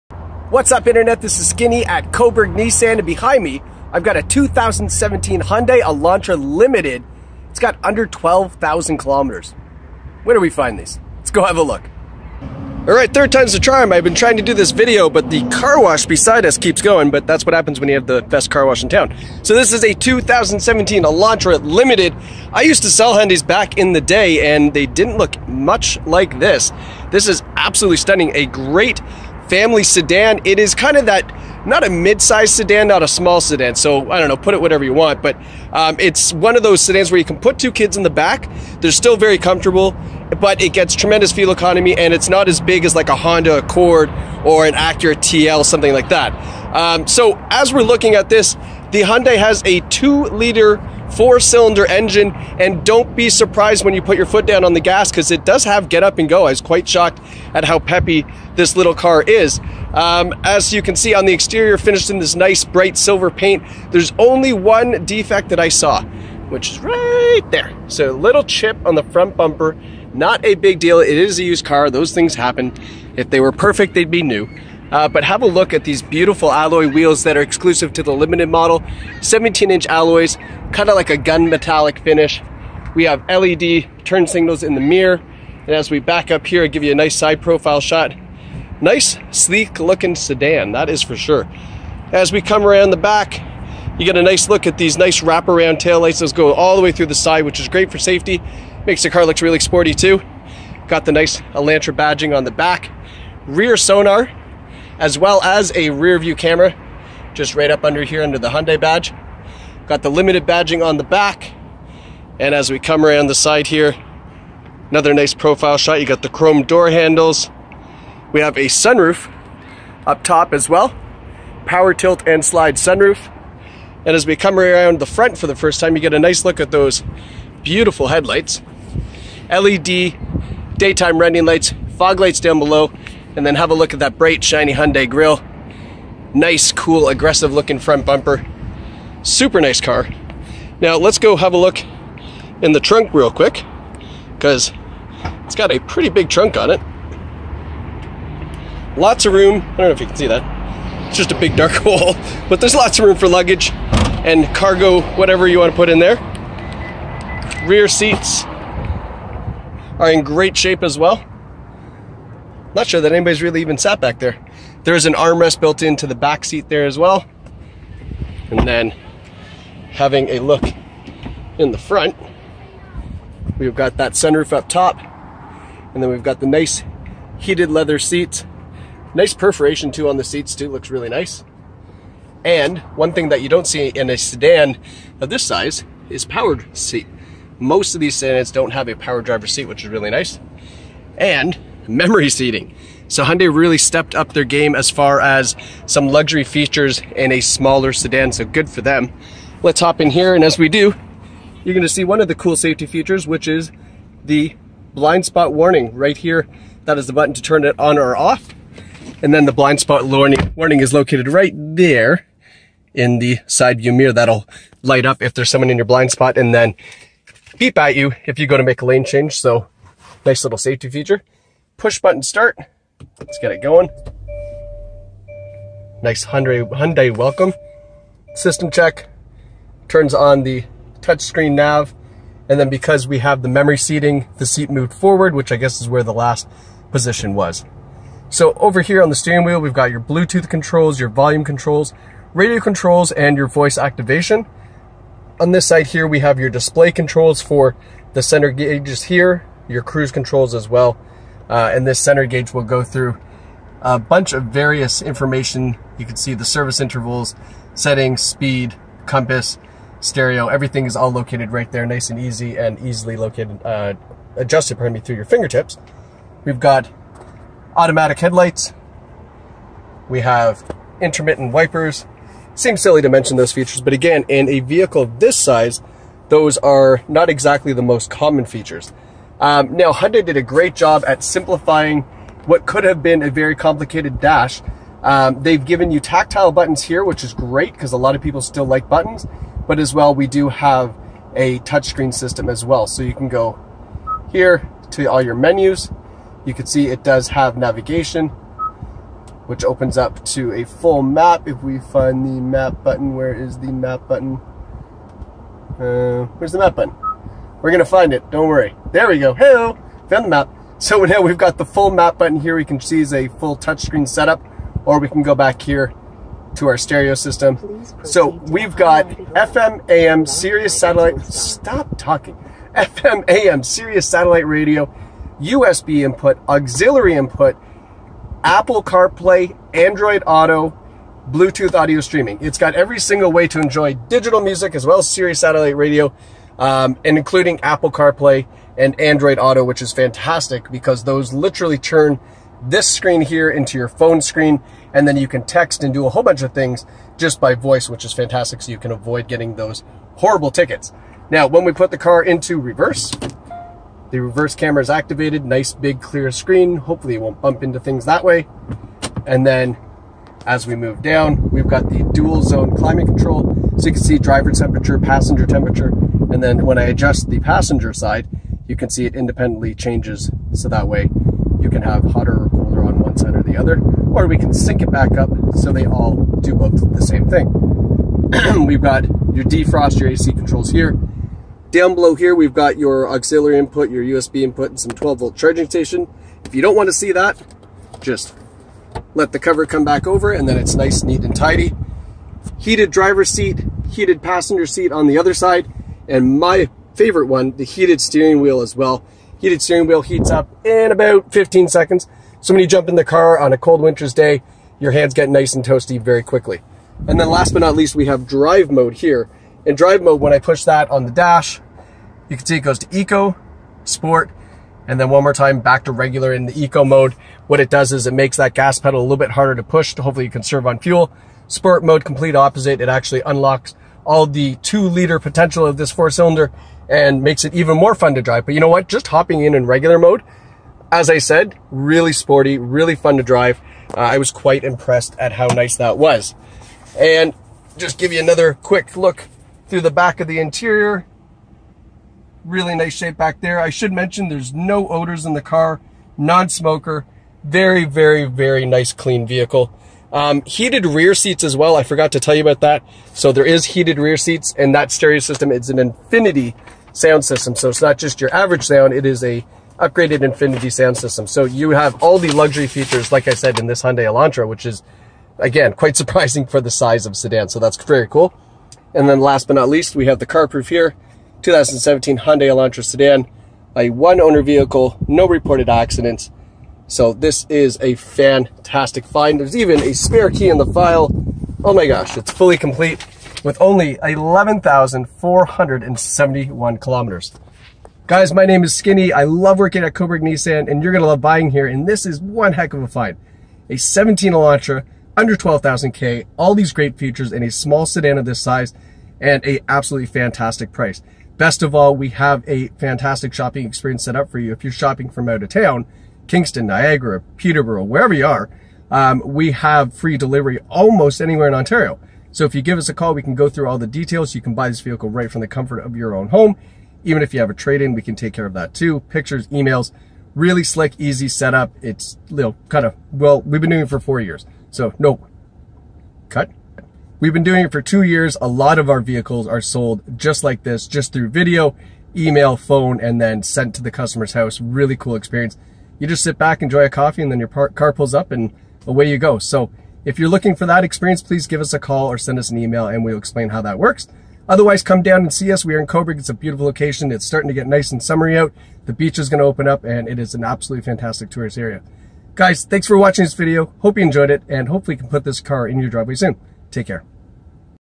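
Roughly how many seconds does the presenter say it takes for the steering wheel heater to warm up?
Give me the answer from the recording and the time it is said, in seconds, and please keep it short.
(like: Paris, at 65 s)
15, at 401 s.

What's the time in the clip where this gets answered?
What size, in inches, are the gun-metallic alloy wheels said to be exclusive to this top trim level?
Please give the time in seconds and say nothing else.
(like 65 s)
79 s.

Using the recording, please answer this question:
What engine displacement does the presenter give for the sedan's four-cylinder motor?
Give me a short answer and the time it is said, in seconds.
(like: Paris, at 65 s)
2 liter, at 49 s.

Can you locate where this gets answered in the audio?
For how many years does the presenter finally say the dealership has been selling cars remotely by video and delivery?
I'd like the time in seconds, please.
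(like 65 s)
527 s.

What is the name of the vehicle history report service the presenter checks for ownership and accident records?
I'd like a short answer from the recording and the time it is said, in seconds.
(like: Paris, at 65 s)
CarProof, at 470 s.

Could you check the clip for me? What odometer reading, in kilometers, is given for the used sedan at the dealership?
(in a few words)
11,471.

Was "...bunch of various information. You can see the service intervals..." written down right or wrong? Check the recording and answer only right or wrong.
right.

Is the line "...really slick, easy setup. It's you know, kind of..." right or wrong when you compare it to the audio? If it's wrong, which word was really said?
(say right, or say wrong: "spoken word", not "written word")
right.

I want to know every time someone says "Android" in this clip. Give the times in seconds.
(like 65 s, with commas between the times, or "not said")
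329 s, 338 s.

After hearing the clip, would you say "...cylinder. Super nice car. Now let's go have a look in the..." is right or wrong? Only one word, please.
wrong.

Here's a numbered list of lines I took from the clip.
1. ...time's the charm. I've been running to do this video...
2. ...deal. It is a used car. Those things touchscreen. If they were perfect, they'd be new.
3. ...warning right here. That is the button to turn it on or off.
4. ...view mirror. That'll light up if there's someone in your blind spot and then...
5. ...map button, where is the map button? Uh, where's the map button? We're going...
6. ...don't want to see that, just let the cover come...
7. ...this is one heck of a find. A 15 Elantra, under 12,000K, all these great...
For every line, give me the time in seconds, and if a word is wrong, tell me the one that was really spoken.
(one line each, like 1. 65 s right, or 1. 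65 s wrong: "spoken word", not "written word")
1. 13 s wrong: "trying", not "running"
2. 70 s wrong: "happen", not "touchscreen"
3. 205 s right
4. 213 s right
5. 302 s right
6. 386 s right
7. 491 s wrong: "17", not "15".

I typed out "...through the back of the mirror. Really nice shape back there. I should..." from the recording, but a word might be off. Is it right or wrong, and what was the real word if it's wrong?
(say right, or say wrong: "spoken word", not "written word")
wrong: "interior", not "mirror".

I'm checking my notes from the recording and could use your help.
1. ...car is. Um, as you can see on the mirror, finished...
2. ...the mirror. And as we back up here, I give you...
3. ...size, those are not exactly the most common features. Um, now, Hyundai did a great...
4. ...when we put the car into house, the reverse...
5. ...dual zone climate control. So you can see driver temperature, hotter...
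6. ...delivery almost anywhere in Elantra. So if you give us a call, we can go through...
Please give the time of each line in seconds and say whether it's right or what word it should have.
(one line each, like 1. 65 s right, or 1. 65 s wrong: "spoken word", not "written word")
1. 58 s wrong: "exterior", not "mirror"
2. 84 s right
3. 275 s right
4. 351 s wrong: "reverse", not "house"
5. 362 s wrong: "passenger", not "hotter"
6. 510 s wrong: "Ontario", not "Elantra".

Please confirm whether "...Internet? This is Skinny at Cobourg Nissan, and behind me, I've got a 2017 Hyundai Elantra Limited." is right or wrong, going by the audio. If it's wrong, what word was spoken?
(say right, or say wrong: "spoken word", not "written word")
right.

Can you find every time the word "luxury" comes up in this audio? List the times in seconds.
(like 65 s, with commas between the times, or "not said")
196 s, 462 s.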